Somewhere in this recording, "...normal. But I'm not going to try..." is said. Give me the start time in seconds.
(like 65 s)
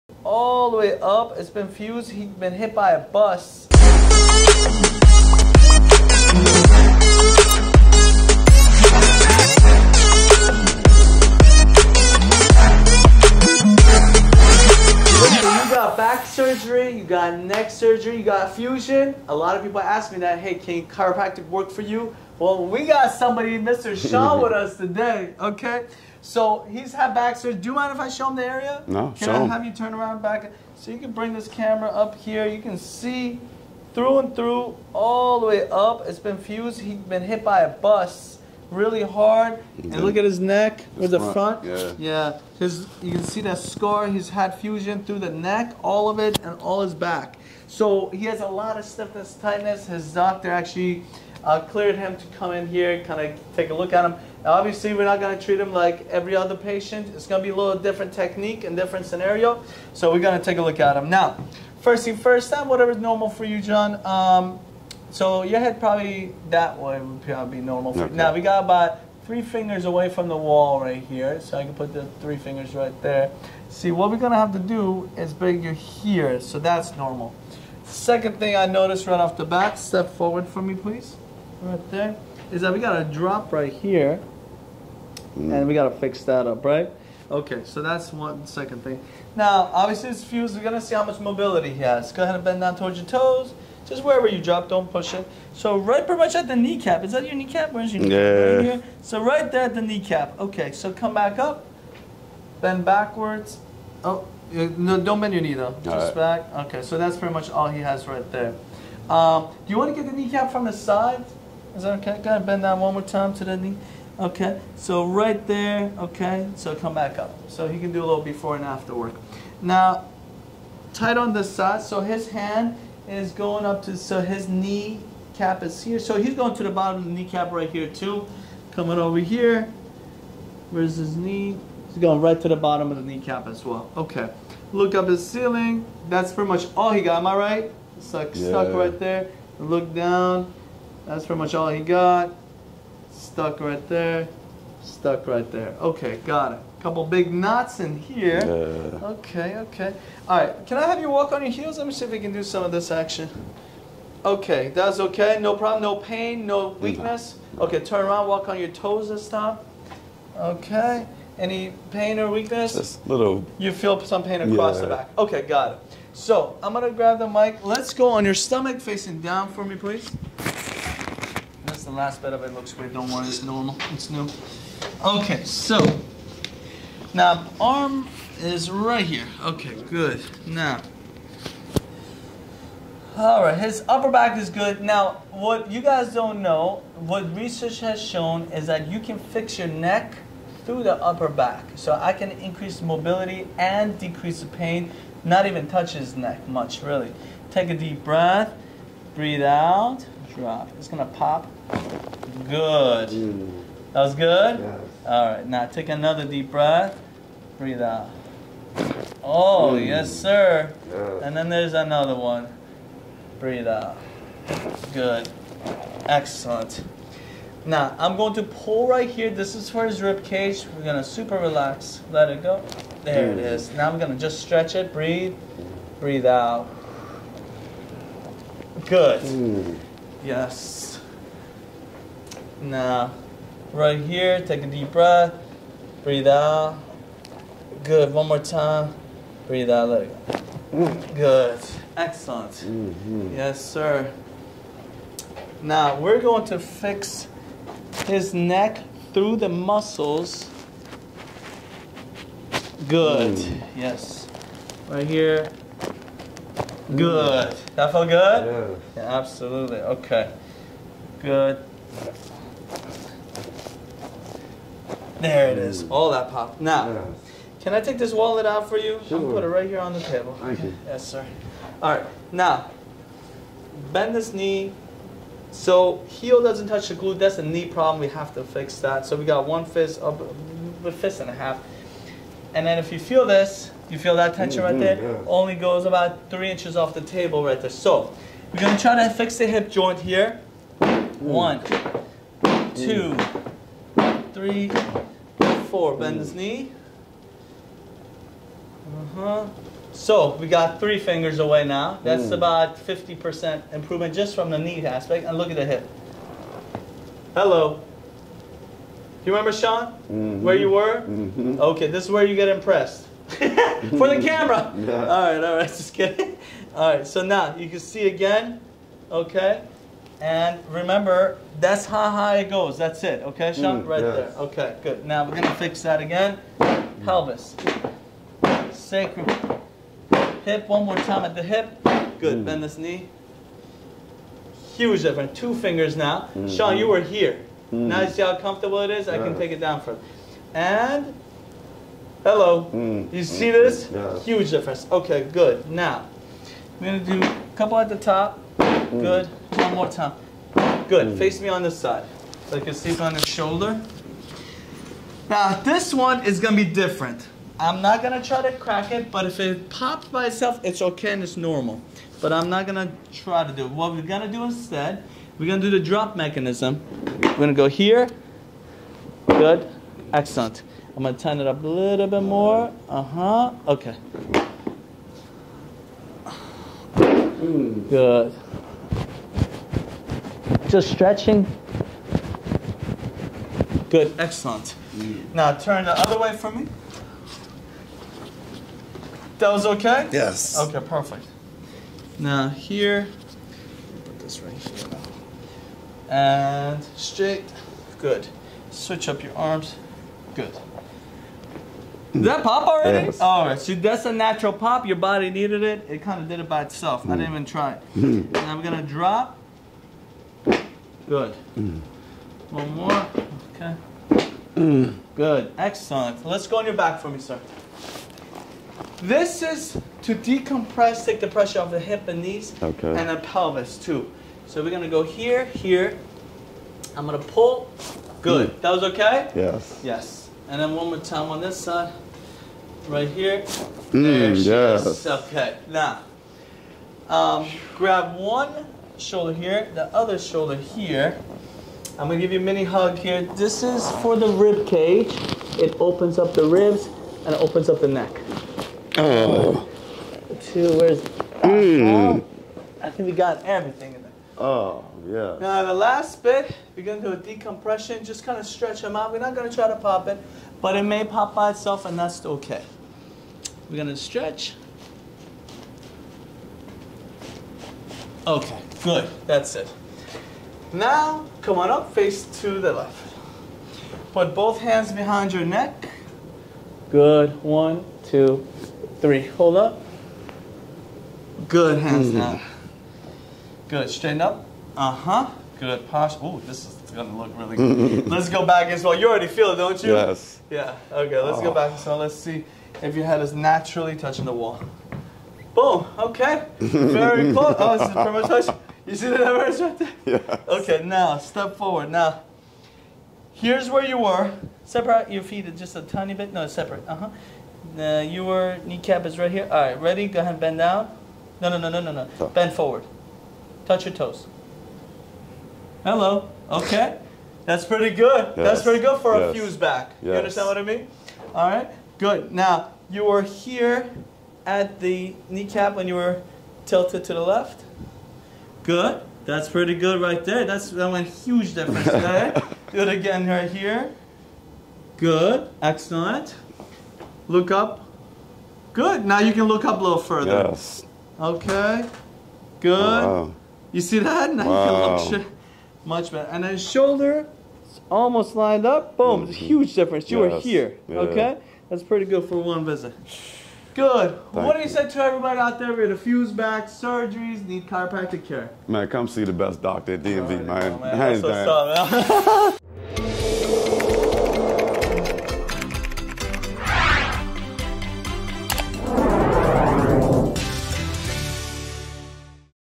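361 s.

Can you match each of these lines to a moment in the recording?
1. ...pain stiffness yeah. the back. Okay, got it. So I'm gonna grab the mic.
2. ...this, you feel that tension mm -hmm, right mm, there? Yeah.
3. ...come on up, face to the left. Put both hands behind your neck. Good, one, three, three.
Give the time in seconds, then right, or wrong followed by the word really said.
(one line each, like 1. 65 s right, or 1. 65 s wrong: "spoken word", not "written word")
1. 164 s wrong: "across", not "stiffness"
2. 283 s right
3. 471 s wrong: "two", not "three".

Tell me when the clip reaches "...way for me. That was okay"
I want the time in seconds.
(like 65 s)
386 s.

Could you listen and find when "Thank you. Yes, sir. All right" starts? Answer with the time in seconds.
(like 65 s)
270 s.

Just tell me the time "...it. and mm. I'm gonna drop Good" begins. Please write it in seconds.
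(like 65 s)
407 s.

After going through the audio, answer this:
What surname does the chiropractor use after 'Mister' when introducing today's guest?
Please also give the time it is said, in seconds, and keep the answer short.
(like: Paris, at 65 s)
Shaw, at 24 s.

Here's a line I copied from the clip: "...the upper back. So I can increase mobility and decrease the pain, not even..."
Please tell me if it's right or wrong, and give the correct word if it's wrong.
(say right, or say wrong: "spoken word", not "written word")
right.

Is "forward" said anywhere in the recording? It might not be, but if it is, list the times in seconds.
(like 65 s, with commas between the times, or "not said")
80 s, 501 s, 512 s.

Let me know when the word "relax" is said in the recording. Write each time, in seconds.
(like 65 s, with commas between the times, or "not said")
221 s.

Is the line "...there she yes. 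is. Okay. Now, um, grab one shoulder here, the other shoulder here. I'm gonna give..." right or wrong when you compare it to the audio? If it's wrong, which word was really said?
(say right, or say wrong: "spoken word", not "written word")
right.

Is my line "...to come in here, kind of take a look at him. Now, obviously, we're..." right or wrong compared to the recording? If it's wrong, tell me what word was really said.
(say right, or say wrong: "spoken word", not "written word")
right.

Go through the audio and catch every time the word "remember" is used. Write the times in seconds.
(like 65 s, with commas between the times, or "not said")
309 s, 320 s.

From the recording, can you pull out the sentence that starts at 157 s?
Okay, turn around, walk on your toes this time.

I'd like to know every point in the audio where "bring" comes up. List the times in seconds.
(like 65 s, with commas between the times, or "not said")
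31 s, 75 s.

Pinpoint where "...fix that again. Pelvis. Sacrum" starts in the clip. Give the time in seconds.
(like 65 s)
325 s.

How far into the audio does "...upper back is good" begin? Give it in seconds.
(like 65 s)
183 s.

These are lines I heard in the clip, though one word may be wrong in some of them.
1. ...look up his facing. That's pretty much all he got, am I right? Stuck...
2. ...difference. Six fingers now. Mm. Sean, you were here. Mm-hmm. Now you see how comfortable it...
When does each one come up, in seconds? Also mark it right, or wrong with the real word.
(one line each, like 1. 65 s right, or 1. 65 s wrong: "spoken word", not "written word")
1. 134 s wrong: "ceiling", not "facing"
2. 335 s wrong: "Two", not "Six".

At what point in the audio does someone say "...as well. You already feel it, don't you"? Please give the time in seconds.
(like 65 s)
488 s.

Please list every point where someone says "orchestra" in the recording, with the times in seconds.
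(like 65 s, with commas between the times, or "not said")
not said.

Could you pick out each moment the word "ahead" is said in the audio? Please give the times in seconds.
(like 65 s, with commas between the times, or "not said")
92 s, 112 s, 510 s.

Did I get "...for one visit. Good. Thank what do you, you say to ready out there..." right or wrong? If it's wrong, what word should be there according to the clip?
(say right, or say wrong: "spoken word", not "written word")
wrong: "everybody", not "ready".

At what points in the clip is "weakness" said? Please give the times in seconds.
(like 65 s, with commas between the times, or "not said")
156 s, 162 s.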